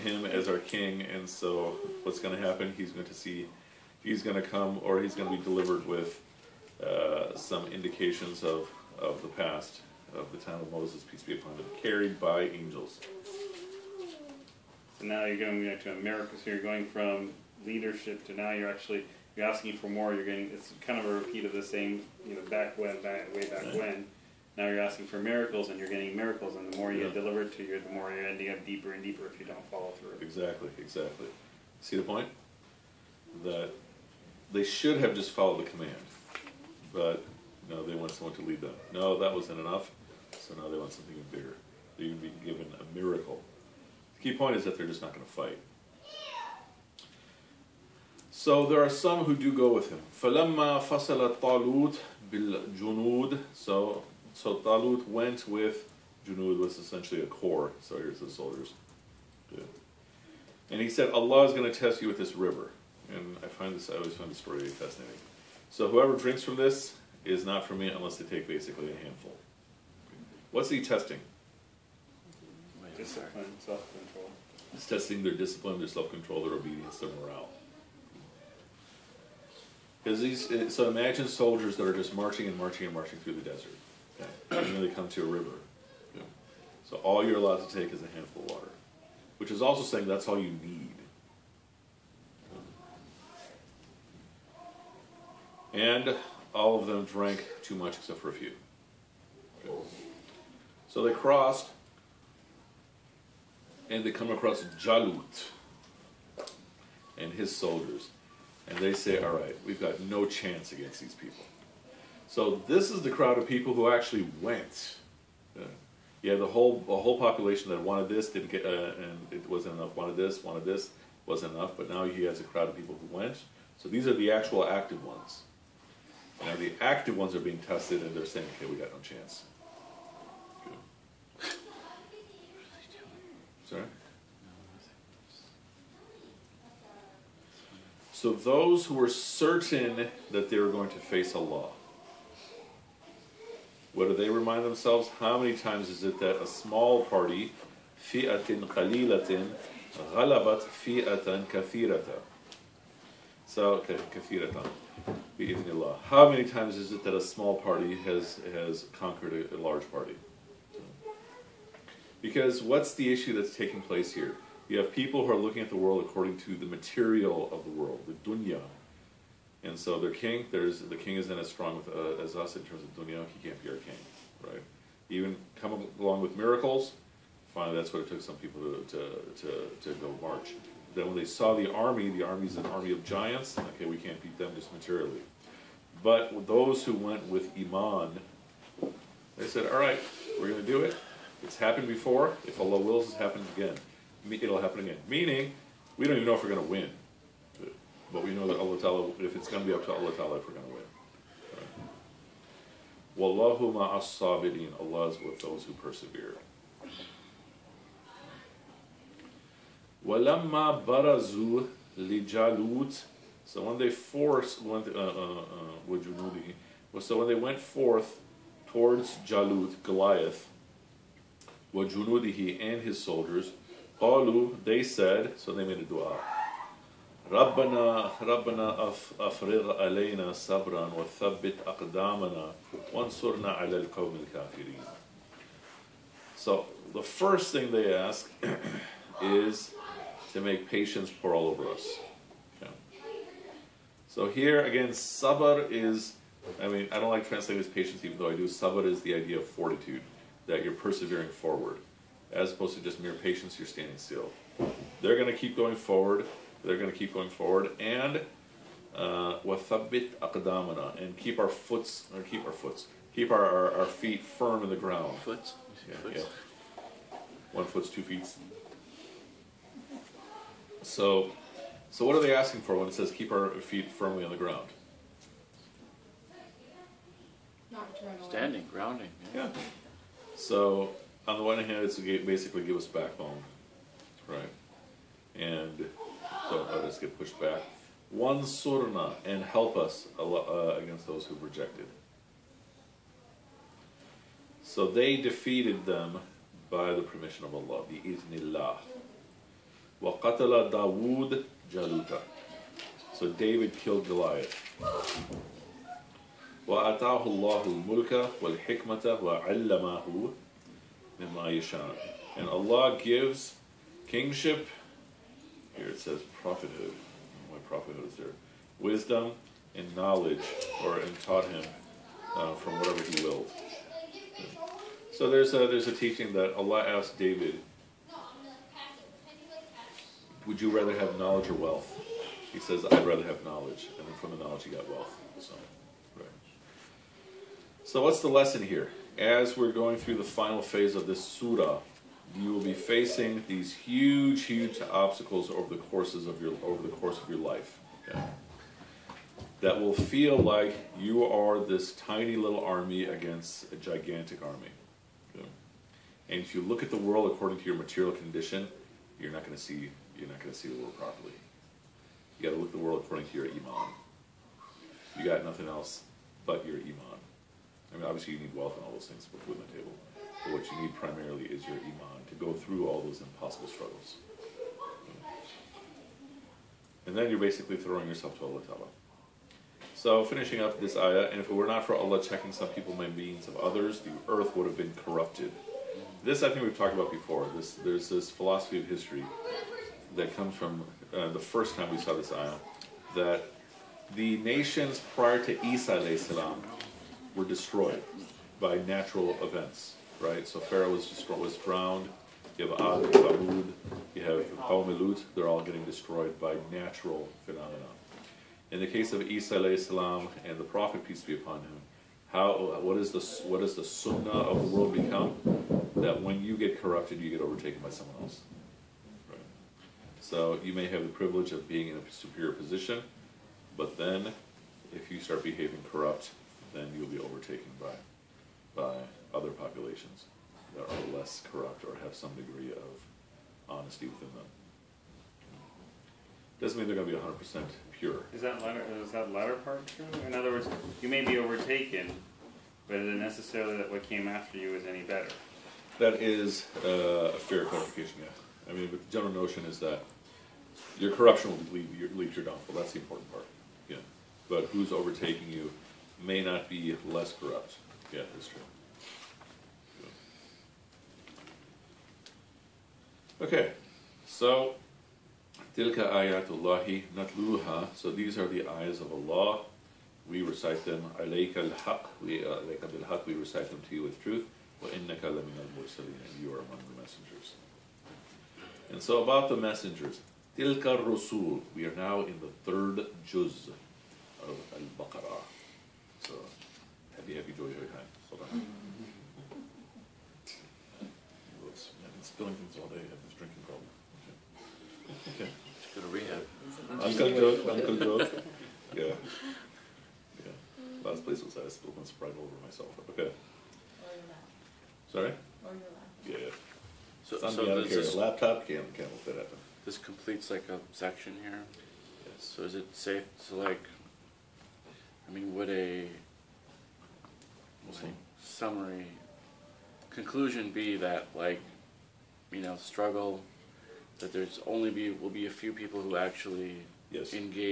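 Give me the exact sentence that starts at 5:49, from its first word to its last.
That will feel like you are this tiny little army against a gigantic army.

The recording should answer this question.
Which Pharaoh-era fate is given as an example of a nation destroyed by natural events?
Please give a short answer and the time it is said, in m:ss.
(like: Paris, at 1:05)
Drowned, at 6:41.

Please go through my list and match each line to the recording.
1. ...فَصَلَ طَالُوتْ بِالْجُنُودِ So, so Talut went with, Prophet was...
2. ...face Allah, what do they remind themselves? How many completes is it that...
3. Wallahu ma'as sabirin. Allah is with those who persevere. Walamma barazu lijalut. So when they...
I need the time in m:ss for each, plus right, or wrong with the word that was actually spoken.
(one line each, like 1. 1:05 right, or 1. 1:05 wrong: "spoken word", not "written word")
1. 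0:50 wrong: "Junud", not "Prophet"
2. 2:20 wrong: "times", not "completes"
3. 3:23 right.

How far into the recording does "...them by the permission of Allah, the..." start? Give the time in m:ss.
4:55.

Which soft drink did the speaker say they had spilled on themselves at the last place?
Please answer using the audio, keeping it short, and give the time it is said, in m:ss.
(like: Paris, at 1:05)
Sprite, at 8:22.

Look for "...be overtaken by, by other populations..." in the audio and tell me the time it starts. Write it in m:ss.
7:07.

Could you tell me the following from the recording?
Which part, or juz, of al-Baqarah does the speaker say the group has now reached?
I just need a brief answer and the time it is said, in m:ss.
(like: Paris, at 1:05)
The third juz, at 8:02.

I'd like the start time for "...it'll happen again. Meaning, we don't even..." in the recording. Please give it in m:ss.
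3:14.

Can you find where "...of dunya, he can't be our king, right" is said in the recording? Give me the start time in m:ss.
2:52.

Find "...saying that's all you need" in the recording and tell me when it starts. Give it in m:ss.
1:29.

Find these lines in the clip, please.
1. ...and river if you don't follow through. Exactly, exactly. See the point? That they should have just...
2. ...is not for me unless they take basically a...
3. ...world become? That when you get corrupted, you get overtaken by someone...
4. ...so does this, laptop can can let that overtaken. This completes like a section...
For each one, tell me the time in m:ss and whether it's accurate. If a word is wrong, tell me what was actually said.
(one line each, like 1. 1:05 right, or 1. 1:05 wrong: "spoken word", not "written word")
1. 0:28 wrong: "deeper", not "river"
2. 1:07 right
3. 6:54 right
4. 8:27 wrong: "happen", not "overtaken".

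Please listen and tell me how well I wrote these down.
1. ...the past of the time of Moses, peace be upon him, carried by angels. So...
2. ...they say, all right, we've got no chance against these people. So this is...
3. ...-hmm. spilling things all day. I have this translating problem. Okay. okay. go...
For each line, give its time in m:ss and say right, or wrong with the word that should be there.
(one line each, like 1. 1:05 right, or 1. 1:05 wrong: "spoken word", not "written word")
1. 0:09 right
2. 1:48 right
3. 8:08 wrong: "drinking", not "translating".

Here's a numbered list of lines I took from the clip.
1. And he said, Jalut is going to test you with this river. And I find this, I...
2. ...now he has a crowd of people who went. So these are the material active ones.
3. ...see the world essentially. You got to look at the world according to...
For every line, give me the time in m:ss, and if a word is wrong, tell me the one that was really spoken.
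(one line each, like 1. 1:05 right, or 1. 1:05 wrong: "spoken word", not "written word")
1. 1:00 wrong: "Allah", not "Jalut"
2. 2:01 wrong: "actual", not "material"
3. 6:00 wrong: "properly", not "essentially".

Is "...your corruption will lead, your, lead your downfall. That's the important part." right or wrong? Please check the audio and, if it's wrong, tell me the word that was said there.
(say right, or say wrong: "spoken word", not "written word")
right.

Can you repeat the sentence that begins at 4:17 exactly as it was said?
And وَثَبِّتْ uh, أَقْدَامَنَا And keep our foots, or keep our foots, keep our, our, our feet firm in the ground.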